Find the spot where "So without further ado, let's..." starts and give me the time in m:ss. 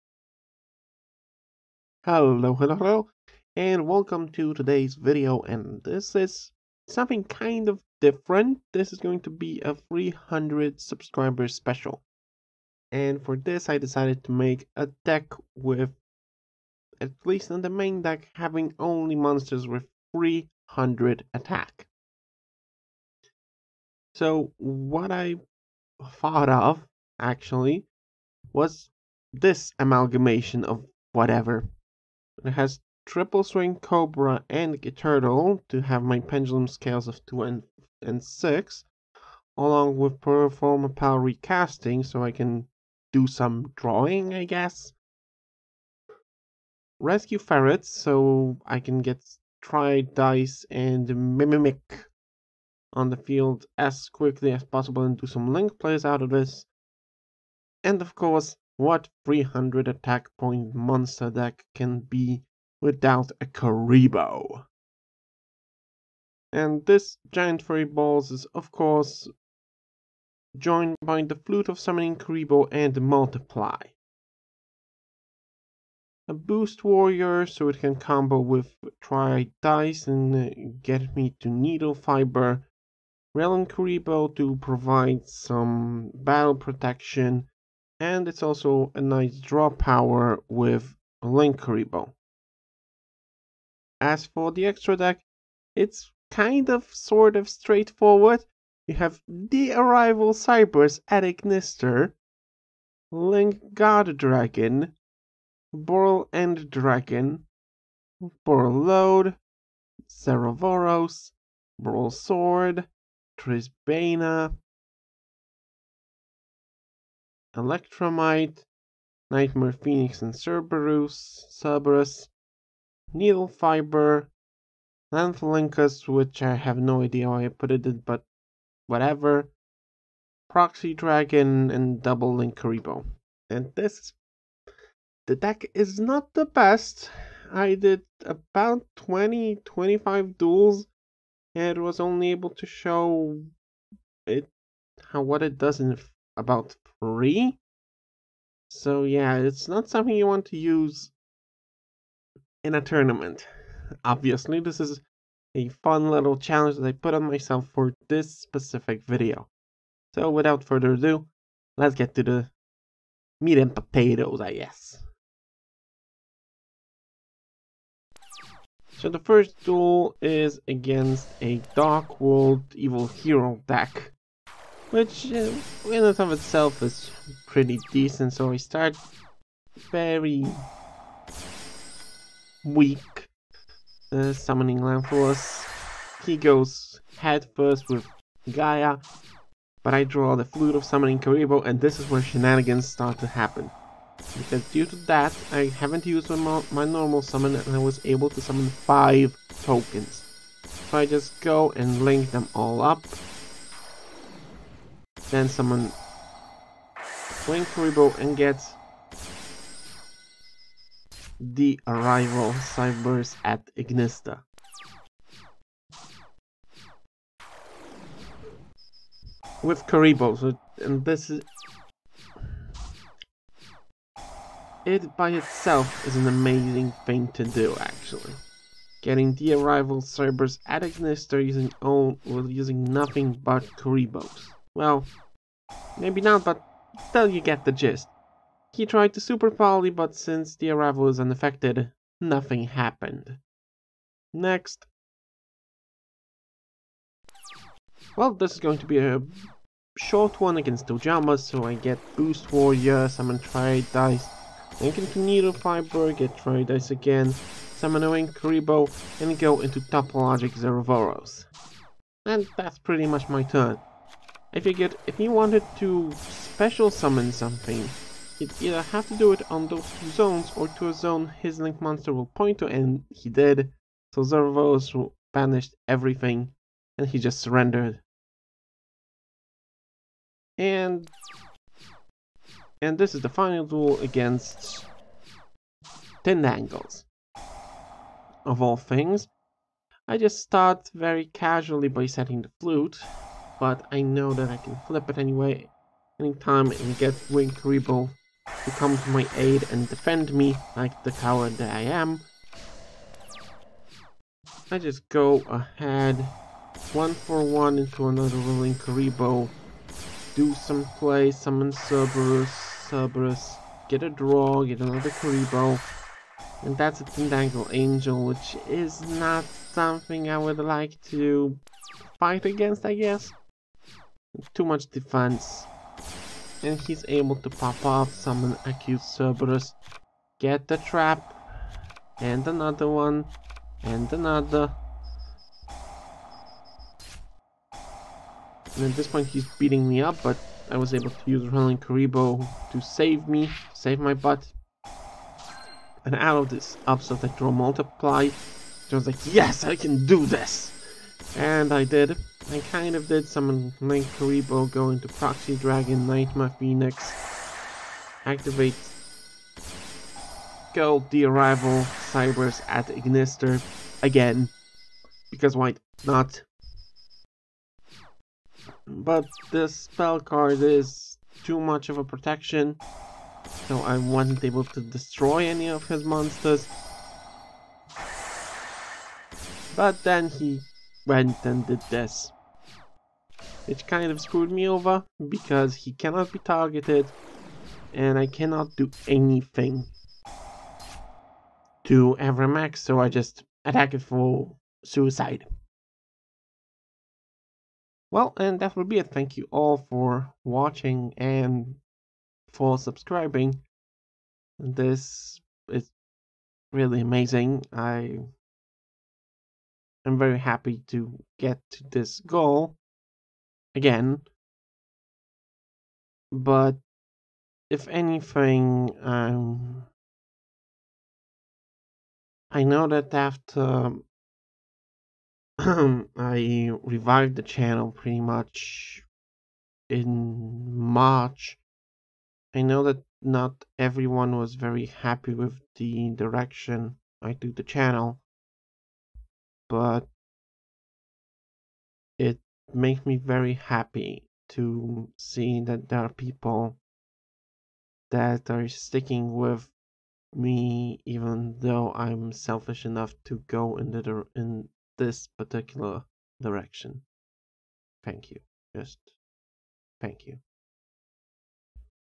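2:40.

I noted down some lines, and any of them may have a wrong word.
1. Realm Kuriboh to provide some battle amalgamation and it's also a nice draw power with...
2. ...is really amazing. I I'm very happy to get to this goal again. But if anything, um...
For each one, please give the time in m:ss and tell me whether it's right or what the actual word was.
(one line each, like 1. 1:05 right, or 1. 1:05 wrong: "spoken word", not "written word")
1. 1:23 wrong: "protection", not "amalgamation"
2. 6:45 right.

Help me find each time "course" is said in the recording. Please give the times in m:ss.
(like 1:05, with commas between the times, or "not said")
0:58, 1:08.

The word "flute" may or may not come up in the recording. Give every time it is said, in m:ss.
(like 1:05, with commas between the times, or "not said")
1:11, 3:10, 4:52.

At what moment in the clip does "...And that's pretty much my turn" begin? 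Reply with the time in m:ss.
4:22.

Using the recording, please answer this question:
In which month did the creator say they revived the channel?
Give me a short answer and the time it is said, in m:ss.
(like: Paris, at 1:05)
March, at 7:10.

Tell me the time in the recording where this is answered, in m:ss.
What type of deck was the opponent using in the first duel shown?
2:51.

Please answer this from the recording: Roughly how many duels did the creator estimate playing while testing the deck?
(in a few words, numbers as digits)
20, 25.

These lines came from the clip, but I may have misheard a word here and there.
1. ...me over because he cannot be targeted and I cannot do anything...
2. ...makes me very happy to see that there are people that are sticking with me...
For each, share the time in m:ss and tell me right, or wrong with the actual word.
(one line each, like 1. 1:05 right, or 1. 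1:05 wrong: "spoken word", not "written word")
1. 6:24 right
2. 7:22 right.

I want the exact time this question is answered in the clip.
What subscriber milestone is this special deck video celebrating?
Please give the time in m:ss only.
0:09.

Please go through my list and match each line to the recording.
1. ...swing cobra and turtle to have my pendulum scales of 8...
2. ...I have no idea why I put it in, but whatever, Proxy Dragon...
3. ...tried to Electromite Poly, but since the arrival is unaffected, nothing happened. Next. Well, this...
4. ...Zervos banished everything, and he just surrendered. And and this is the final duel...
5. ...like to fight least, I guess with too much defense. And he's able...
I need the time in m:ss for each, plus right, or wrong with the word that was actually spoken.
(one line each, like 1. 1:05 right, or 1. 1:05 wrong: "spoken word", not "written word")
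1. 0:33 wrong: "2", not "8"
2. 2:06 right
3. 3:58 wrong: "Super", not "Electromite"
4. 4:34 right
5. 5:20 wrong: "against", not "least".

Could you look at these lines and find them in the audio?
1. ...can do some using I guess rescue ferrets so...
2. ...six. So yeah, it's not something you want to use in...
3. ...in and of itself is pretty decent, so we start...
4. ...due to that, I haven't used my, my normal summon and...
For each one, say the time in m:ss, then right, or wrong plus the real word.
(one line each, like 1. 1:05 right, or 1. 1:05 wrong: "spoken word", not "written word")
1. 0:42 wrong: "drawing", not "using"
2. 2:26 wrong: "three", not "six"
3. 2:55 right
4. 3:14 right.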